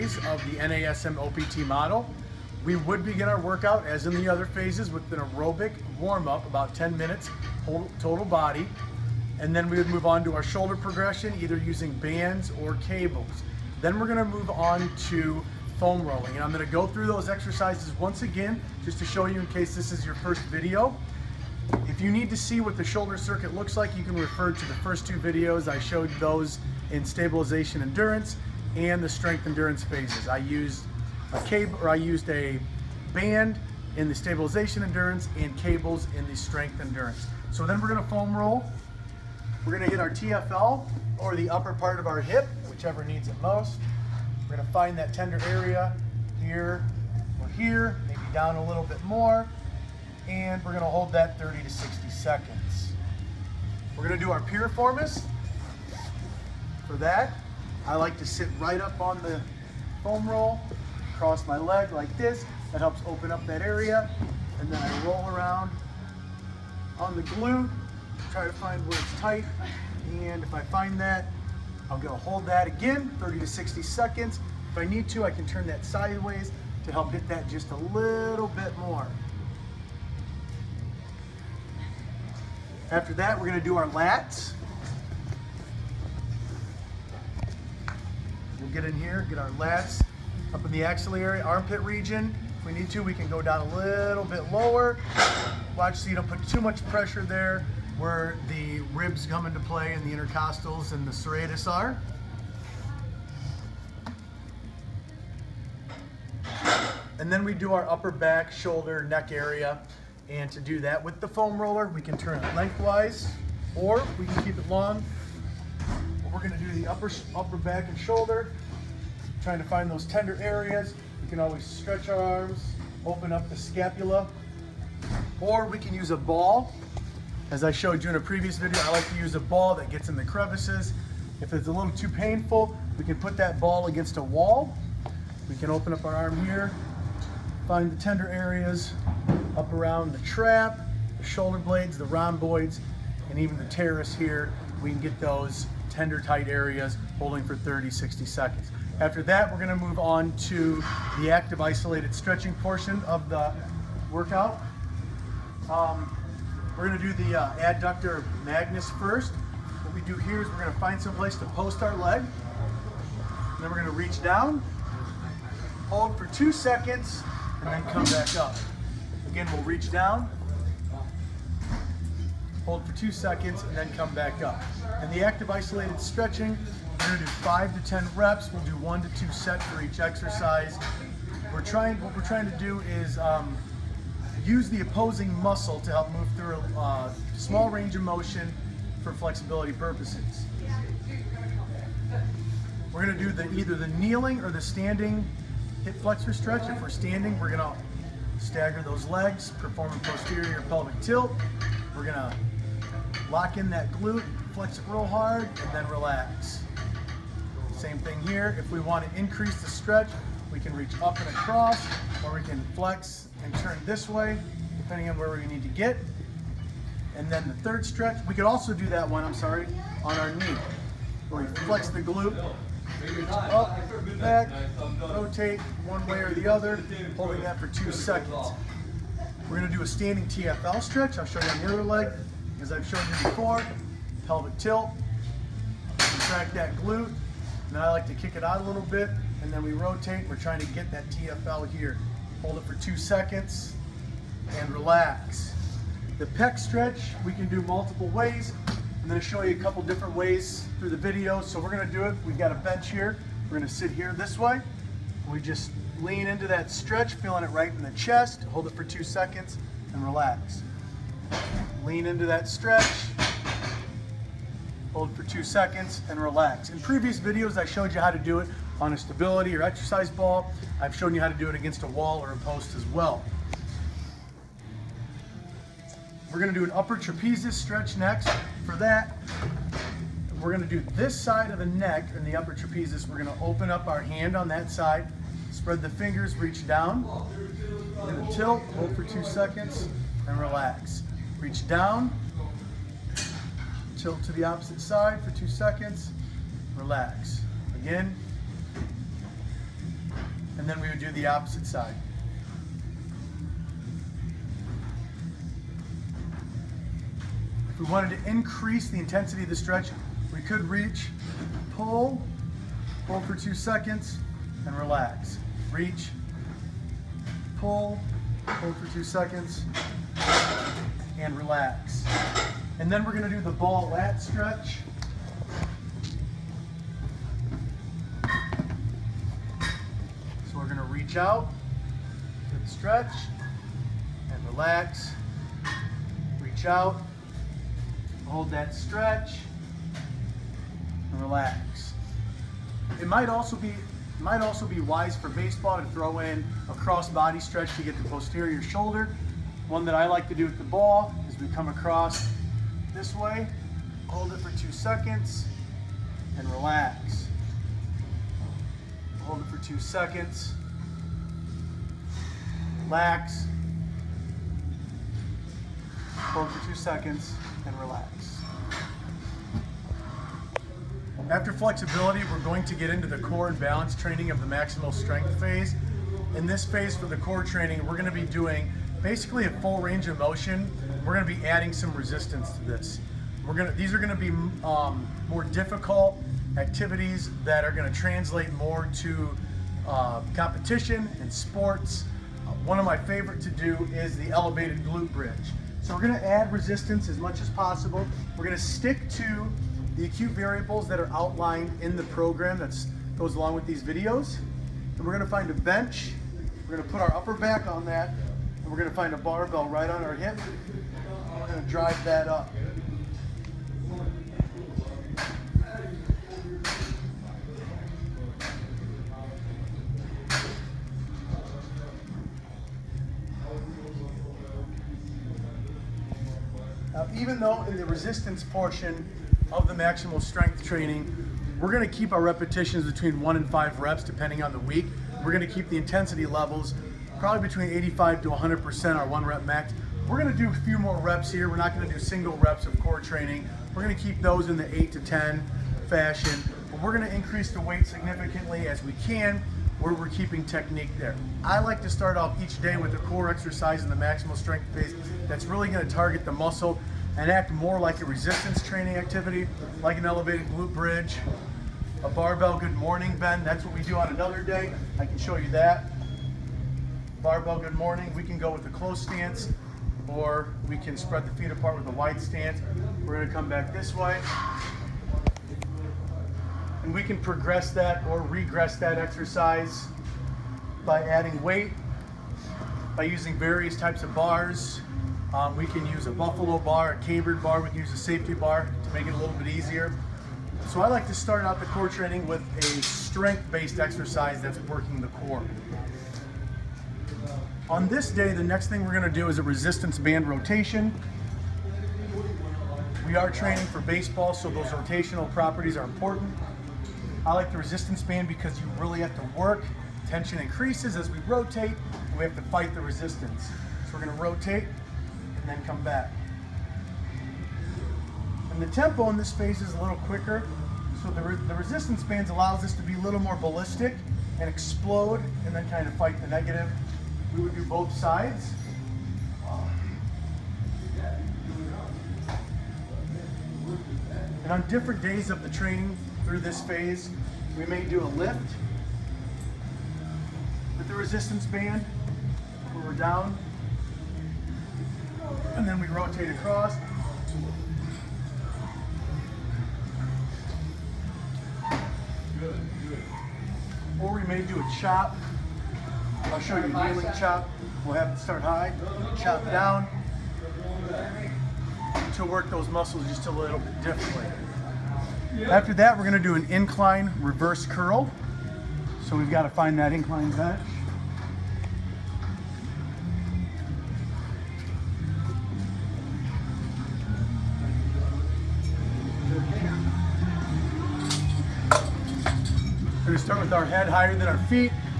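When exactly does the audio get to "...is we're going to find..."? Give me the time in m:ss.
2:40.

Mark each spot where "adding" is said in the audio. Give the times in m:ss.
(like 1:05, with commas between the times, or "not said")
6:21, 8:01.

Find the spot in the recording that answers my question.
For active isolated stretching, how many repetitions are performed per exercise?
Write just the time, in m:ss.
2:57.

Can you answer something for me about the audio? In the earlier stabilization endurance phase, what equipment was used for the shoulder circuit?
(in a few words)
a band.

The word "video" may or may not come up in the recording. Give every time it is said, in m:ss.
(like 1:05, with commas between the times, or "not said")
0:20, 0:25, 2:08, 4:10, 4:27, 6:43.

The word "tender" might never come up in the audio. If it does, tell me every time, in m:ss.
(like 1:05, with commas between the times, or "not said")
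0:45, 2:00, 2:18, 2:25.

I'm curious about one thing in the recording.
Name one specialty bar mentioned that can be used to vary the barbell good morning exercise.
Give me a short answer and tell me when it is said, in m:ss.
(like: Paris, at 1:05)
buffalo bar, at 8:06.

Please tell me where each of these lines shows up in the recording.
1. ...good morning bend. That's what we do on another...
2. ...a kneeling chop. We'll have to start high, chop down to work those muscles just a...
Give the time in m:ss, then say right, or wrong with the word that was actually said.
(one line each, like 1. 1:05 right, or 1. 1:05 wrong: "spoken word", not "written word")
1. 7:42 right
2. 9:16 right.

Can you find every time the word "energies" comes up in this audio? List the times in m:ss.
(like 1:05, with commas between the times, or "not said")
not said.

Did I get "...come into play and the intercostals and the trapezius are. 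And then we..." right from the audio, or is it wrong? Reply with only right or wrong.
wrong.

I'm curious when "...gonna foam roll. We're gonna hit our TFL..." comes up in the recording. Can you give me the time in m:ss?
0:37.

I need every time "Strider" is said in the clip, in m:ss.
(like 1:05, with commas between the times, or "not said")
not said.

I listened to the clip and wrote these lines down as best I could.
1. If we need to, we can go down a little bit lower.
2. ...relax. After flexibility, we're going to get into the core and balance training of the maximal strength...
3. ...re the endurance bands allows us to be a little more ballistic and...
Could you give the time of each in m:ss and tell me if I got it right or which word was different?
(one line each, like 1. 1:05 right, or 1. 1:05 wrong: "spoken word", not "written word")
1. 1:32 right
2. 6:07 right
3. 8:41 wrong: "resistance", not "endurance".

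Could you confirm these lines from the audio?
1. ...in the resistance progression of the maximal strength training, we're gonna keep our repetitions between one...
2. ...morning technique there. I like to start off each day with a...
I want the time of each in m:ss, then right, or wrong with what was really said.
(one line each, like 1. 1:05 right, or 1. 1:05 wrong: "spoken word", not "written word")
1. 7:07 wrong: "portion", not "progression"
2. 7:30 wrong: "keeping", not "morning".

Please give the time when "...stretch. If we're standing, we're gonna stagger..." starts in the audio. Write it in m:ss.
3:16.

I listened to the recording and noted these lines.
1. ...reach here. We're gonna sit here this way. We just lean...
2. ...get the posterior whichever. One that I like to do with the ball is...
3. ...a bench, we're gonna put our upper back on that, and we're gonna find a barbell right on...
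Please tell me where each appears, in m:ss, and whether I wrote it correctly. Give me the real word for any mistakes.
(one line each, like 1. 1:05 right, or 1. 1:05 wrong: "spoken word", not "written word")
1. 4:12 wrong: "bench", not "reach"
2. 5:47 wrong: "shoulder", not "whichever"
3. 6:45 right.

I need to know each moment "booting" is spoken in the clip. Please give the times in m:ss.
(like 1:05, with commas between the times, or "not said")
not said.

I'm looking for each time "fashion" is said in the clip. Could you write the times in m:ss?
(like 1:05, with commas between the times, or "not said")
7:25.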